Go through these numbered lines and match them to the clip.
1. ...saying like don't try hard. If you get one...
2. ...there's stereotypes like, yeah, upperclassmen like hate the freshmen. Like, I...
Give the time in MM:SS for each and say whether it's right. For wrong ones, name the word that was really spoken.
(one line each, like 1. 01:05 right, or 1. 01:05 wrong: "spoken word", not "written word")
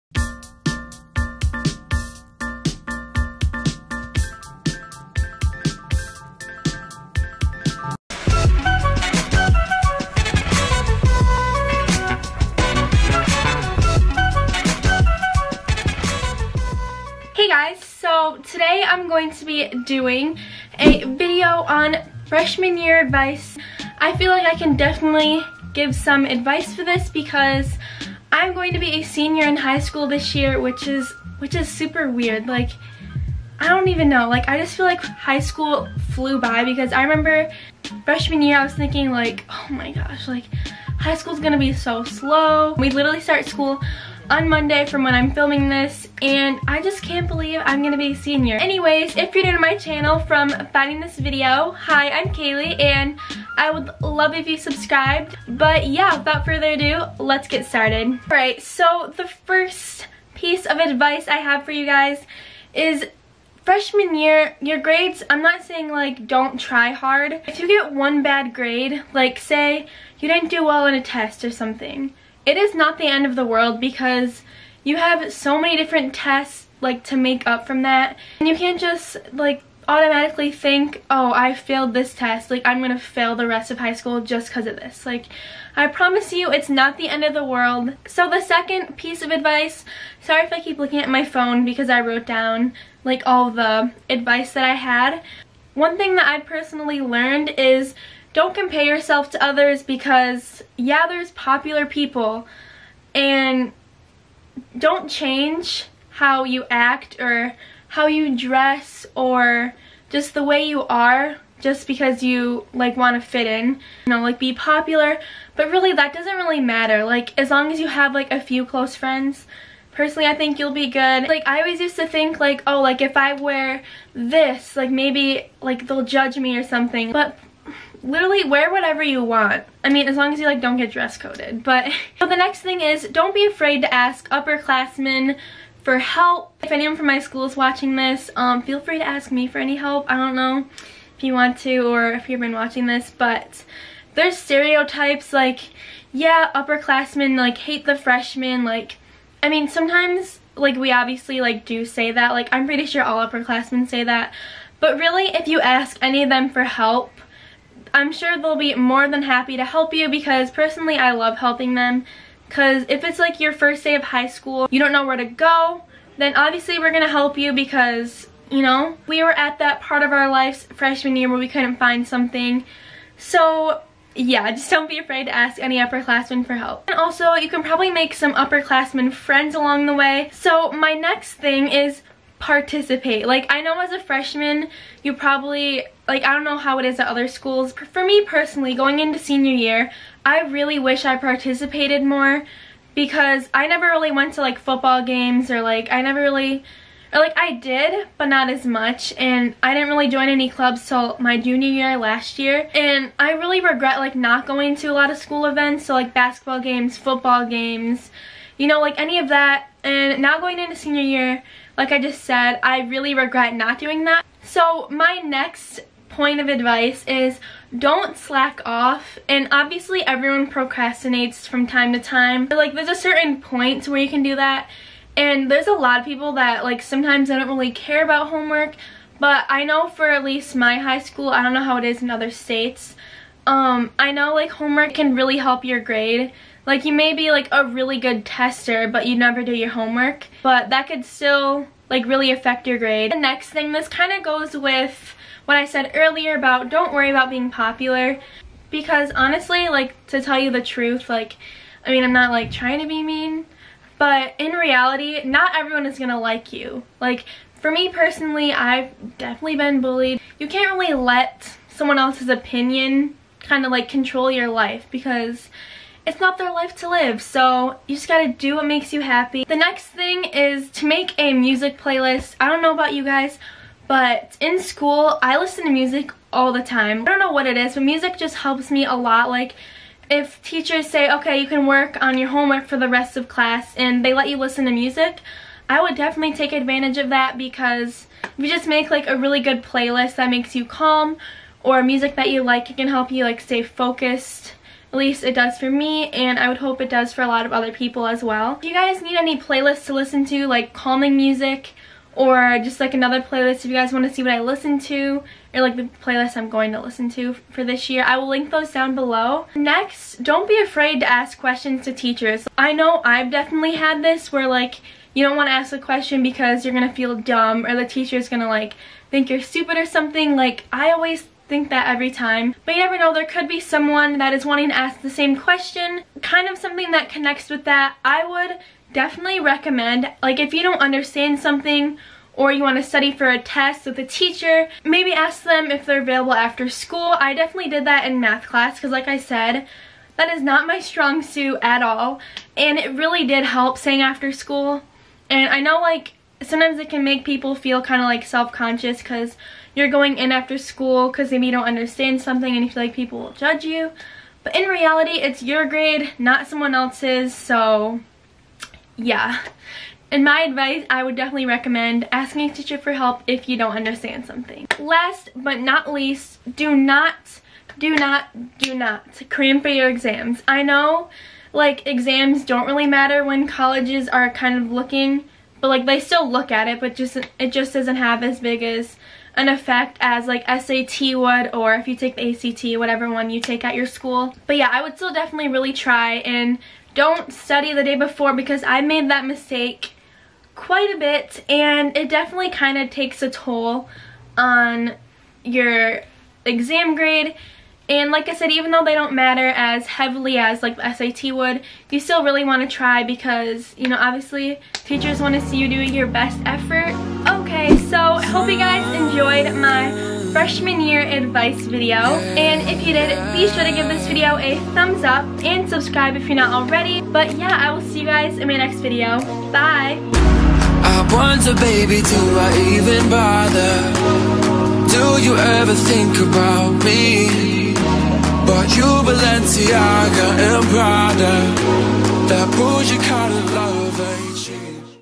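1. 01:05 right
2. 02:24 right.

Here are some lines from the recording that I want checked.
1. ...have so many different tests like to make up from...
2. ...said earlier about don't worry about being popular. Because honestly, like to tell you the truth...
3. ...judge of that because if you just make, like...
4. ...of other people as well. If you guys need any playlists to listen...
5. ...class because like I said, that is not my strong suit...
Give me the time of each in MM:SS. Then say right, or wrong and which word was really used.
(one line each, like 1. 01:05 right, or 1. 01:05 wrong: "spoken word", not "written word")
1. 01:14 right
2. 04:05 right
3. 04:46 wrong: "advantage", not "judge"
4. 04:57 right
5. 05:38 right.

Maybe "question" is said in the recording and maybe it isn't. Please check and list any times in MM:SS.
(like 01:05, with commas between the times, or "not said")
05:11, 05:15, 05:25.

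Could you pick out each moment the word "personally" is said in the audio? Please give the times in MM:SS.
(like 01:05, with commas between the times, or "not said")
01:36, 01:59, 02:40, 03:08, 04:17.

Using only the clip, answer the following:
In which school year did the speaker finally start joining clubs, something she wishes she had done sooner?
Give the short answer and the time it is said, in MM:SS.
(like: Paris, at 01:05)
junior year, at 03:21.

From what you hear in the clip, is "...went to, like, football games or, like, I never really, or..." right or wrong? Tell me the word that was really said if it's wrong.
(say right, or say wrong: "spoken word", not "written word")
right.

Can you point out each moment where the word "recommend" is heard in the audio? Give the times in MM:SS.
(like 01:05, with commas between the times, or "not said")
05:29, 06:01.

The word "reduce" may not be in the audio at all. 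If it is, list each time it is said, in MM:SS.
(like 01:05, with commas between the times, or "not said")
not said.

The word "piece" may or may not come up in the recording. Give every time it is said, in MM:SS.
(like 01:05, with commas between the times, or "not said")
01:00, 01:28.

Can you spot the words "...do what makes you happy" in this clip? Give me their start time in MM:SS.
04:28.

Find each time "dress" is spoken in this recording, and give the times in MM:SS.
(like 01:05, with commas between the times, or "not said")
01:48, 02:10.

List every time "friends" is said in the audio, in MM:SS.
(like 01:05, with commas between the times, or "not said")
01:58, 02:59.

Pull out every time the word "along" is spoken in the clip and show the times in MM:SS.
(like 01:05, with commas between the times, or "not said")
02:59.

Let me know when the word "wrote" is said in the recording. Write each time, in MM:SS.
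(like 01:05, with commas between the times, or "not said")
01:32.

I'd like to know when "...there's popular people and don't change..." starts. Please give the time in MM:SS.
01:41.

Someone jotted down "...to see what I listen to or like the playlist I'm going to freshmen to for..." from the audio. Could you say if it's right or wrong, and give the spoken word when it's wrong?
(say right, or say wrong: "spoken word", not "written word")
wrong: "listen", not "freshmen".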